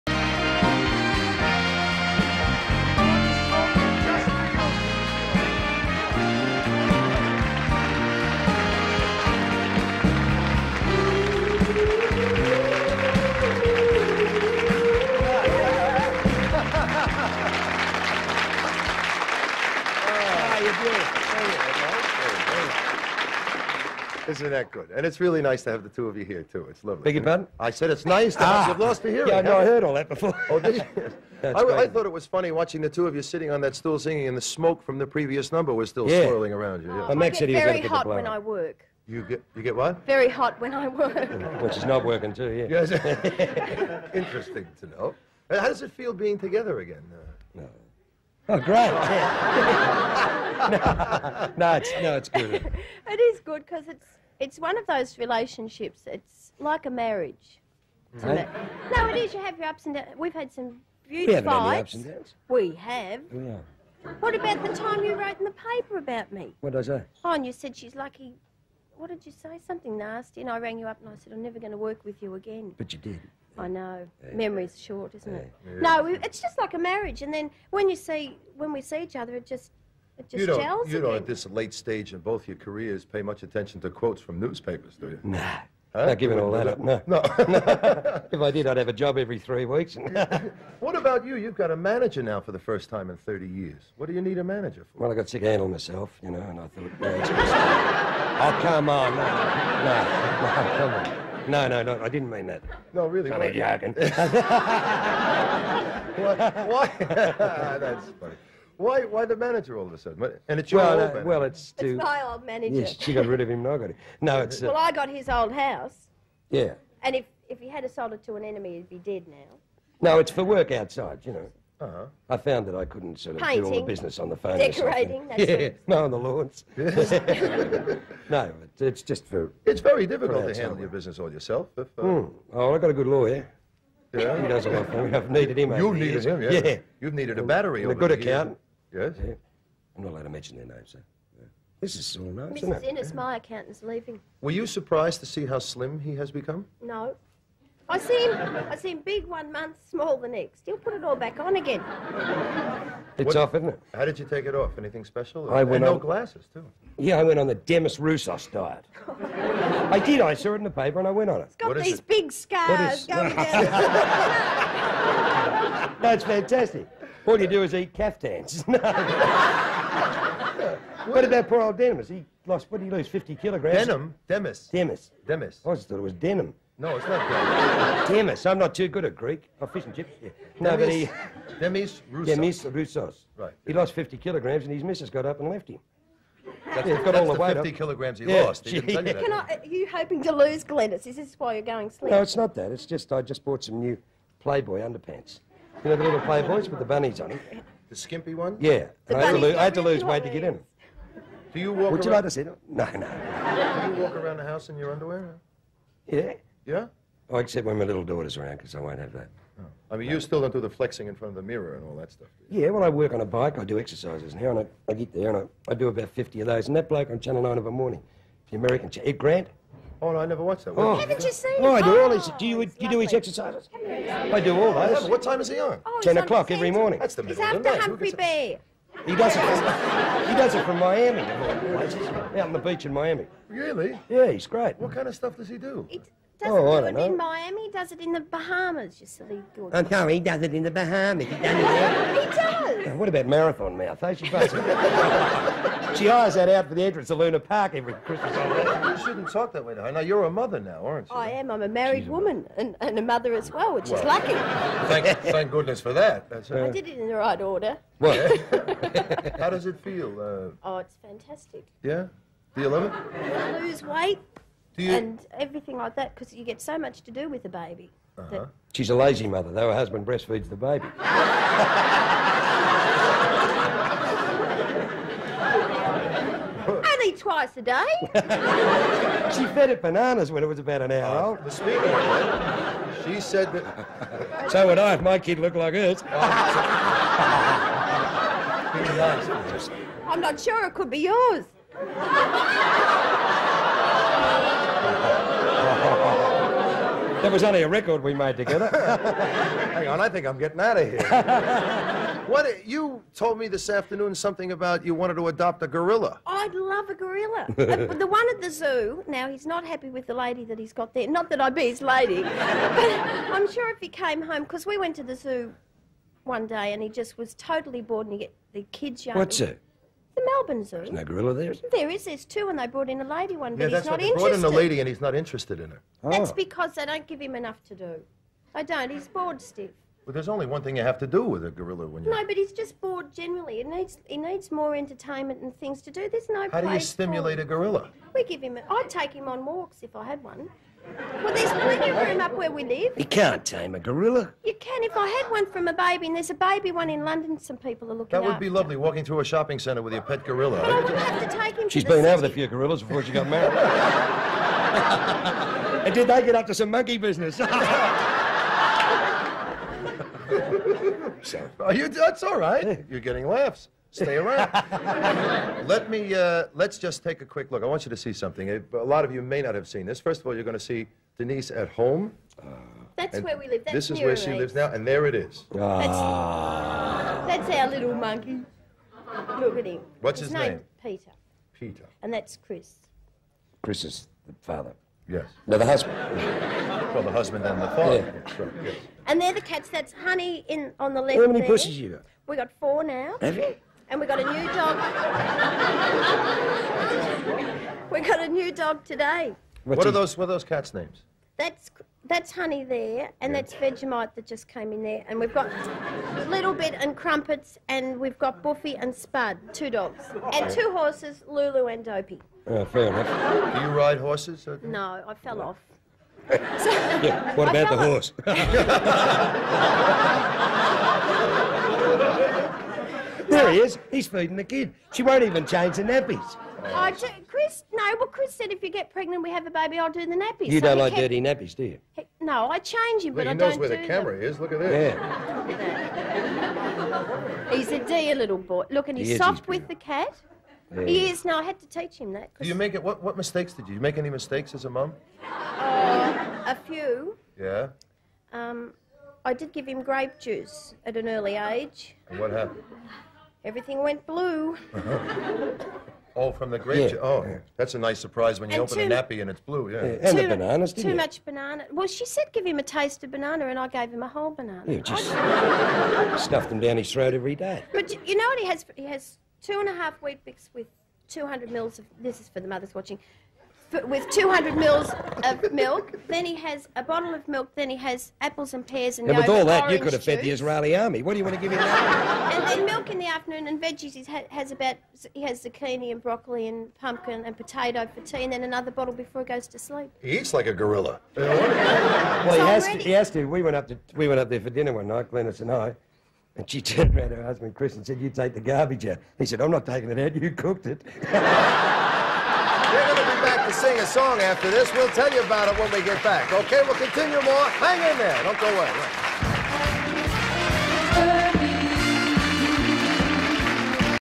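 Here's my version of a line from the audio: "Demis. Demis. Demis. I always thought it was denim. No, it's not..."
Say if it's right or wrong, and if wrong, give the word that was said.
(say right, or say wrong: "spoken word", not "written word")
right.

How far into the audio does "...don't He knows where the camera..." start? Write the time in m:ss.
7:13.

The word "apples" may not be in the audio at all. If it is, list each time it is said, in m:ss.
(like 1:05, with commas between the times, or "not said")
7:58.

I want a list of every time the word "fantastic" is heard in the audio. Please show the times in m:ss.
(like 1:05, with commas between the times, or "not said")
2:46, 4:21.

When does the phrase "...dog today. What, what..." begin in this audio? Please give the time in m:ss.
6:38.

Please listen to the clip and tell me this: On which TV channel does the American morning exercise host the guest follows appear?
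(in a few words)
Channel 9.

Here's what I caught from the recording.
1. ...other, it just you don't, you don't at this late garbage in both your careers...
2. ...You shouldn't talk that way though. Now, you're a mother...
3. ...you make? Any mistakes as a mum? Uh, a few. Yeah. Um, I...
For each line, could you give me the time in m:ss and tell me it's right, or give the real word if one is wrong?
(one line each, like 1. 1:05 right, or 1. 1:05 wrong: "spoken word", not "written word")
1. 1:19 wrong: "stage", not "garbage"
2. 4:08 right
3. 7:23 right.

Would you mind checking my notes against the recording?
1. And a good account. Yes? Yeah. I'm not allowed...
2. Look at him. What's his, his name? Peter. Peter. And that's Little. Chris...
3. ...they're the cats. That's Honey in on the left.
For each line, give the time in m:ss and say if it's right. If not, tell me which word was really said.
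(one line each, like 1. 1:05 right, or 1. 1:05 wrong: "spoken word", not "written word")
1. 2:17 right
2. 6:19 wrong: "Chris", not "Little"
3. 6:29 right.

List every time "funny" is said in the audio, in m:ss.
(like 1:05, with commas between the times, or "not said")
0:32, 1:48.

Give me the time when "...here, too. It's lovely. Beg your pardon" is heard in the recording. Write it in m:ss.
0:26.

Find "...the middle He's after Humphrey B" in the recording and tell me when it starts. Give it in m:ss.
3:47.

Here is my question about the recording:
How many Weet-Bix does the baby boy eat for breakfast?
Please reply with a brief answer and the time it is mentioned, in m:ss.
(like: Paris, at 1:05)
2 and a half, at 7:49.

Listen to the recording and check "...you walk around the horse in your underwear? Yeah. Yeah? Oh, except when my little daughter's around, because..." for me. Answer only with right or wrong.
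wrong.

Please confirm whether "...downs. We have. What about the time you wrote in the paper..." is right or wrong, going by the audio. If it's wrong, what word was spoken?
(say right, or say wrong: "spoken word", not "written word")
right.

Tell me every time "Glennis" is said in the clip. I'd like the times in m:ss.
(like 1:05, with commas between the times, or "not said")
3:10, 8:15.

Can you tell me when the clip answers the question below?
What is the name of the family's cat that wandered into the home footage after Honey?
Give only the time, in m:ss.
6:43.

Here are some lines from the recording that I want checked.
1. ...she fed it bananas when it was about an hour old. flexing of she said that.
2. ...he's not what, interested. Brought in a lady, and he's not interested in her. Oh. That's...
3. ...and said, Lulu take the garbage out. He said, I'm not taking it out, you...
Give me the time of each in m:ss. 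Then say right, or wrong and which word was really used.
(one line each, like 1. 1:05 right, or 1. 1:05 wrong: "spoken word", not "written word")
1. 4:39 wrong: "speaking", not "flexing"
2. 5:23 right
3. 8:17 wrong: "You", not "Lulu".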